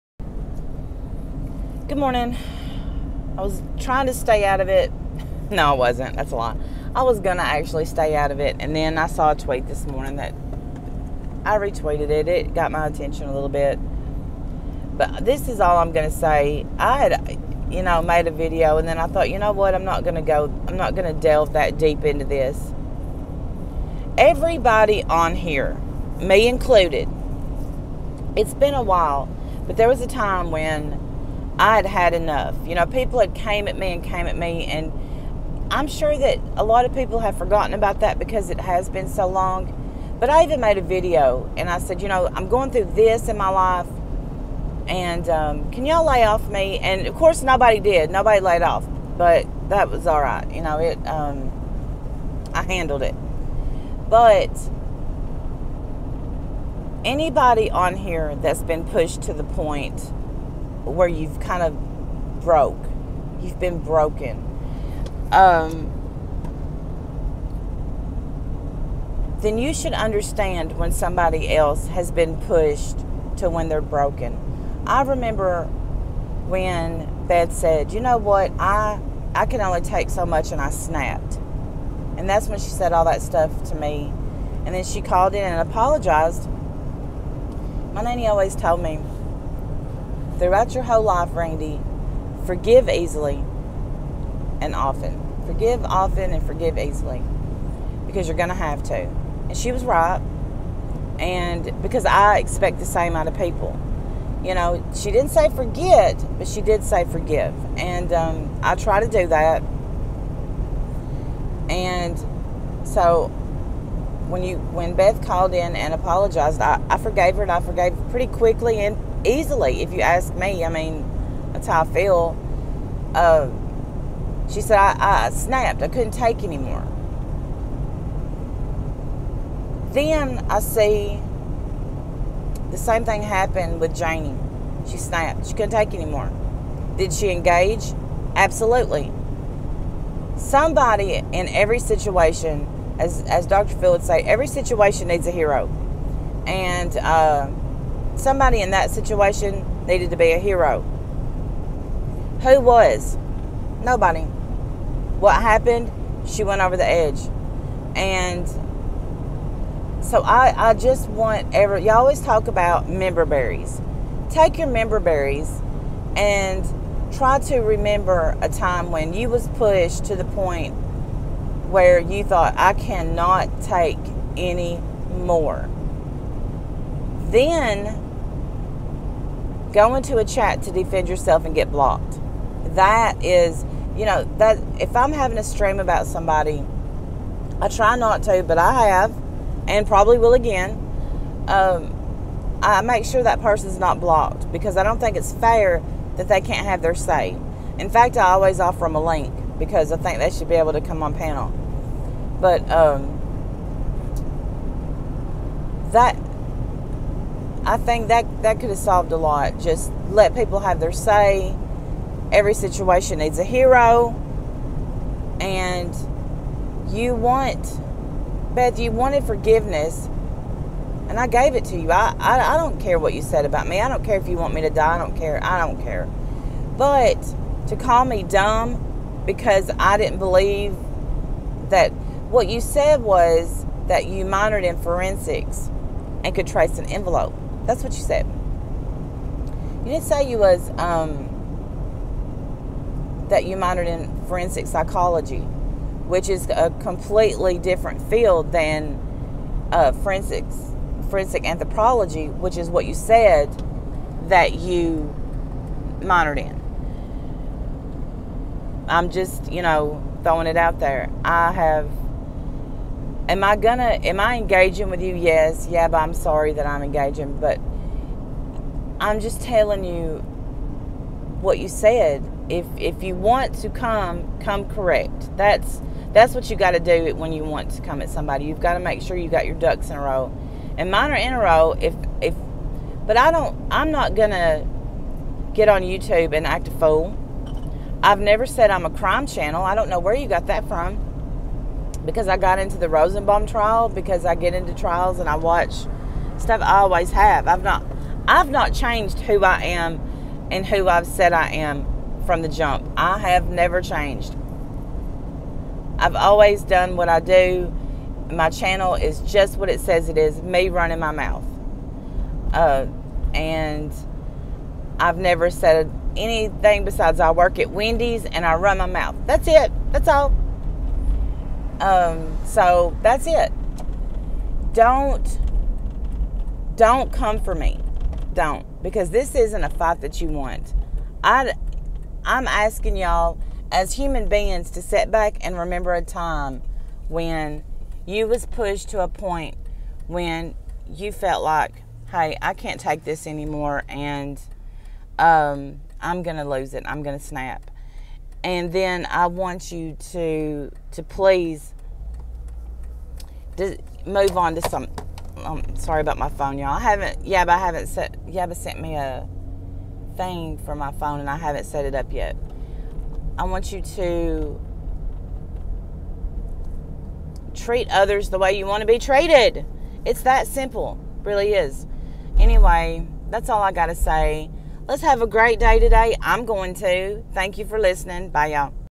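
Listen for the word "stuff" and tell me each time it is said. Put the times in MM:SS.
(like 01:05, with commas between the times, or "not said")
01:23, 04:56.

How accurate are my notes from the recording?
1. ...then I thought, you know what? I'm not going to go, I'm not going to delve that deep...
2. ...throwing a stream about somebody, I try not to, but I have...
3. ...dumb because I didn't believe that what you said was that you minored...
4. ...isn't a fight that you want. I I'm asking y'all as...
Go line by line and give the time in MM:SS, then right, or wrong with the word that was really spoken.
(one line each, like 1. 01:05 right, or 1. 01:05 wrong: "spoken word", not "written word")
1. 00:18 right
2. 03:05 wrong: "having", not "throwing"
3. 03:48 right
4. 05:29 right.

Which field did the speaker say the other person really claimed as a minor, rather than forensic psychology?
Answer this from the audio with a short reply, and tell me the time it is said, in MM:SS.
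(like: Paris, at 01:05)
forensic anthropology, at 04:11.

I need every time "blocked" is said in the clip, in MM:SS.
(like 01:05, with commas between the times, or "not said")
03:01, 03:13.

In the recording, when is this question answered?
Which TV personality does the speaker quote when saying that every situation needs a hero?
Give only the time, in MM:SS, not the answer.
02:23.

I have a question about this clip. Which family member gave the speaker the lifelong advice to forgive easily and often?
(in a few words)
nanny.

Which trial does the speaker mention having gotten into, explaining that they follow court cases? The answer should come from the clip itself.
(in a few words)
Rosenbaum trial.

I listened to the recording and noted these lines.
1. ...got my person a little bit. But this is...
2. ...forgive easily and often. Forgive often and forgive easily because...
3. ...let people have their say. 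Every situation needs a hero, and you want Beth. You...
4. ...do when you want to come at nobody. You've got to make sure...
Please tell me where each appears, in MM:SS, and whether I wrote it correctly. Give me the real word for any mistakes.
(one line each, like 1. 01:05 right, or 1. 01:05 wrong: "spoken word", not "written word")
1. 00:12 wrong: "attention", not "person"
2. 01:32 right
3. 03:30 right
4. 04:36 wrong: "somebody", not "nobody".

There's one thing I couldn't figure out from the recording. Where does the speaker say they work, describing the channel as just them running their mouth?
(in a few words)
Wendy's.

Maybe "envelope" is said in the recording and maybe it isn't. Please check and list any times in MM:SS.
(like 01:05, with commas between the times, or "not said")
03:56.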